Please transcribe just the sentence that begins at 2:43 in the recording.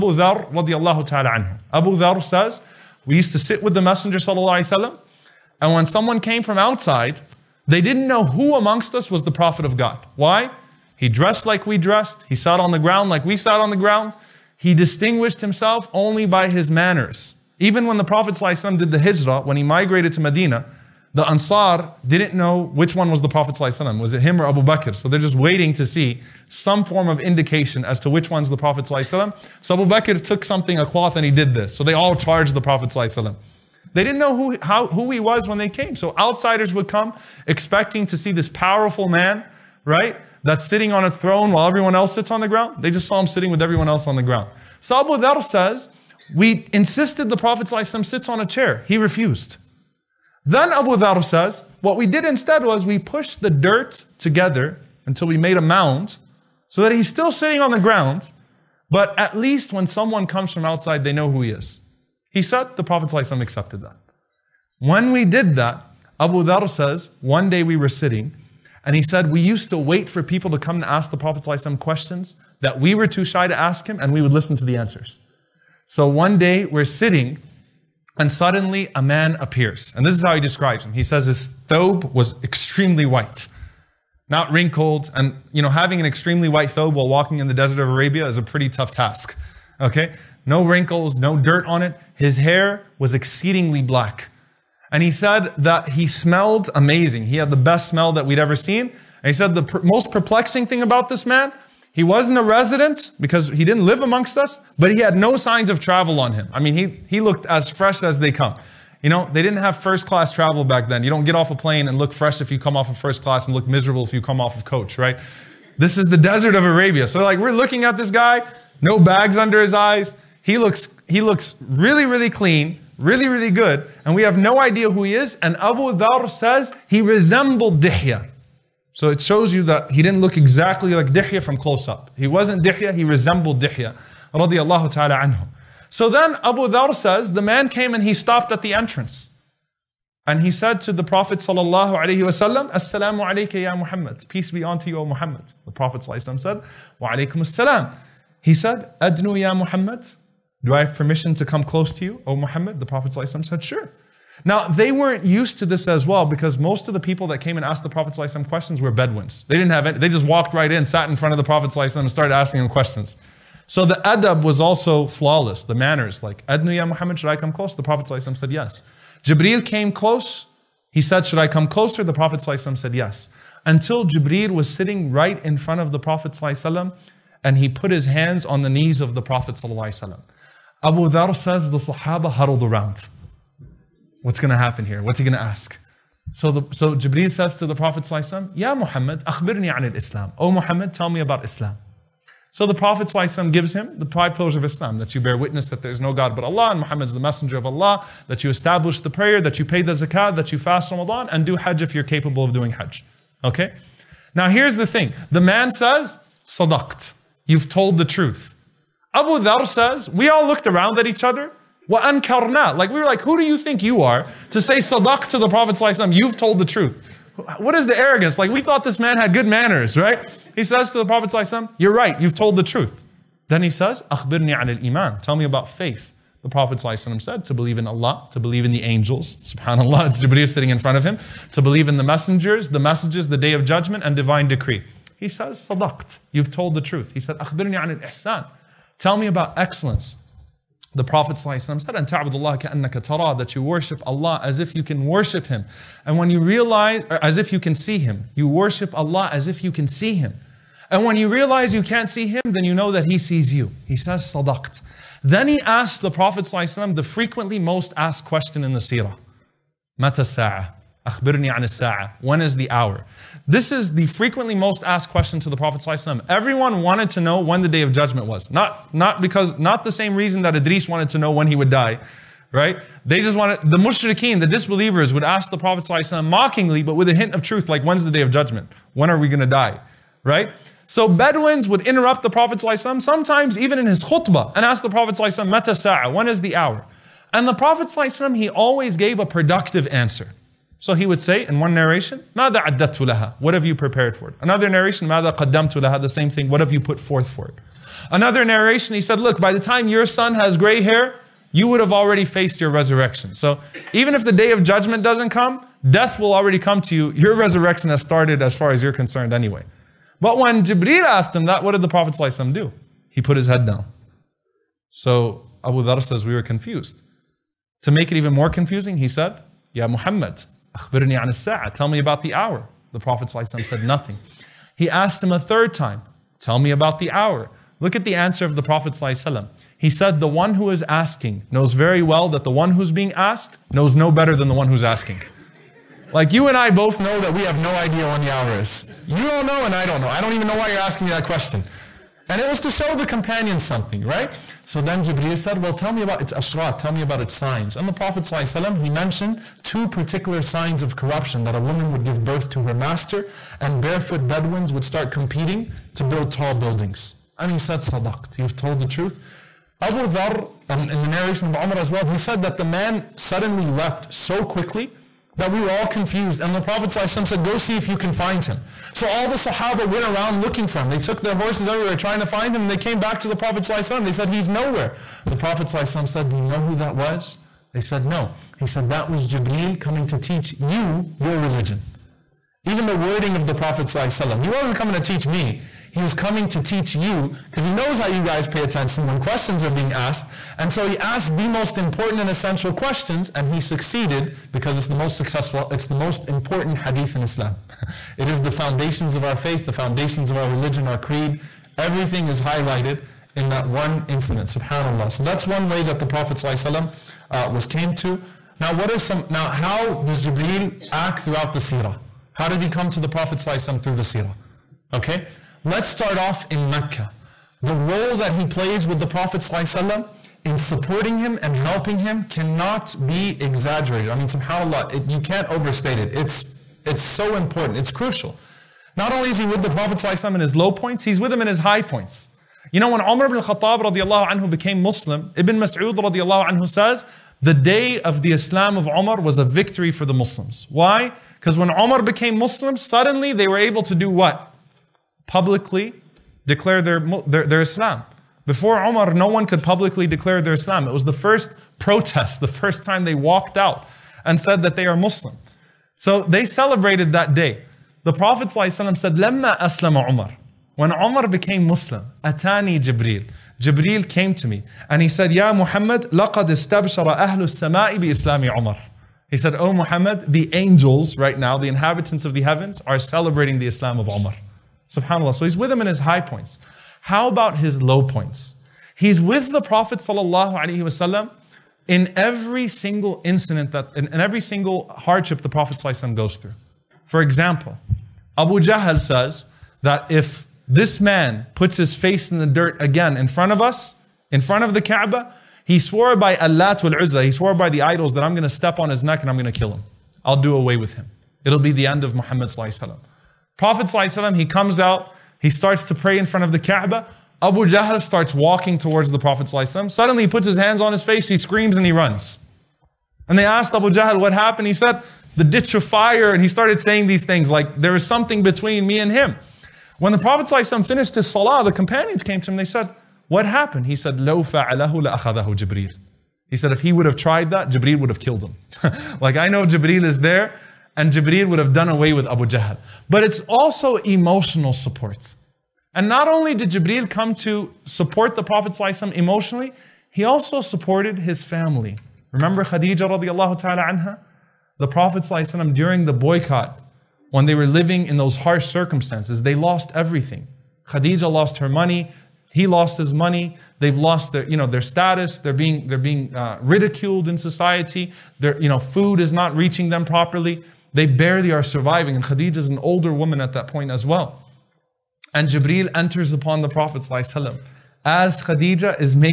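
So the adab was also flawless, the manners, like, Adnu ya Muhammad, should I come close?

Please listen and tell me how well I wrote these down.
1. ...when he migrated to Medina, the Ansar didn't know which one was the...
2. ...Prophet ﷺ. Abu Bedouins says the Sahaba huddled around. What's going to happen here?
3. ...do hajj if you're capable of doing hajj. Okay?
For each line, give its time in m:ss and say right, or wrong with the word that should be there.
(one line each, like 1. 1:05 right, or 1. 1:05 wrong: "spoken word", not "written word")
1. 0:19 right
2. 2:59 wrong: "Dhar", not "Bedouins"
3. 3:21 right.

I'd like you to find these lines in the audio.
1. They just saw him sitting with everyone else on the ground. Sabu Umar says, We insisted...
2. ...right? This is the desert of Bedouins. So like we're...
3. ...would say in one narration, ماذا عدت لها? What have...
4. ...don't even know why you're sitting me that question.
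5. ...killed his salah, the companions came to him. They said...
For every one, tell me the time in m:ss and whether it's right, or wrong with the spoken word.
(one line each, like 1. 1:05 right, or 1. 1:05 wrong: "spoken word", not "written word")
1. 0:42 wrong: "Dhar", not "Umar"
2. 1:54 wrong: "Arabia", not "Bedouins"
3. 4:51 right
4. 5:40 wrong: "asking", not "sitting"
5. 8:40 wrong: "finished", not "killed".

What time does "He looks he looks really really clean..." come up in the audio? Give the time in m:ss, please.
2:00.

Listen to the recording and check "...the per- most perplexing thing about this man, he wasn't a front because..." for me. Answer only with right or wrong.
wrong.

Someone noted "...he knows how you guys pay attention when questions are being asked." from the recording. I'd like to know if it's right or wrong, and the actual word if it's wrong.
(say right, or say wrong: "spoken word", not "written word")
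right.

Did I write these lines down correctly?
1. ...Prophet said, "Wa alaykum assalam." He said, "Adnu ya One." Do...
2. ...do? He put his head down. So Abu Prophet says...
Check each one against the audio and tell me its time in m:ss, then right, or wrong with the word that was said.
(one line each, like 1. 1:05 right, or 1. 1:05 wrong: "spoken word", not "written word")
1. 2:25 wrong: "Muhammad", not "One"
2. 5:12 wrong: "Dhar", not "Prophet".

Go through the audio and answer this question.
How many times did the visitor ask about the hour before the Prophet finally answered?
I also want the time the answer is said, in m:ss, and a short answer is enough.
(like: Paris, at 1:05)
3, at 5:25.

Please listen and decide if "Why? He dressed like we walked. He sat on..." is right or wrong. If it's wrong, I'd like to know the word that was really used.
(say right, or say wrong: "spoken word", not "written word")
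wrong: "dressed", not "walked".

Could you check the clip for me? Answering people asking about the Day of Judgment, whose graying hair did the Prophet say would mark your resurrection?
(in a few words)
Your son.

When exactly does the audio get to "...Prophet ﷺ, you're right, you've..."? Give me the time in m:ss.
3:41.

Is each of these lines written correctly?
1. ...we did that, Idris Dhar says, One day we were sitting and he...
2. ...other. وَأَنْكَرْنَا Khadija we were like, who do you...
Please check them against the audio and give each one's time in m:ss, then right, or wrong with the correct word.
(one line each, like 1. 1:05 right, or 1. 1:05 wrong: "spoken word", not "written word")
1. 1:05 wrong: "Abu", not "Idris"
2. 3:31 wrong: "Like", not "Khadija".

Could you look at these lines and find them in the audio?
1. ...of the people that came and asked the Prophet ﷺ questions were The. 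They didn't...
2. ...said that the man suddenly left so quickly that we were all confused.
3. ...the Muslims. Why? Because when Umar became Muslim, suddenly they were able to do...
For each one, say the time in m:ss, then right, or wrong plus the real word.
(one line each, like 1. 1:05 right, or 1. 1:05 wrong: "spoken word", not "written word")
1. 2:36 wrong: "Bedouins", not "The"
2. 6:02 right
3. 7:20 right.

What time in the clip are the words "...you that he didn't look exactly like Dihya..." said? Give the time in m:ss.
2:09.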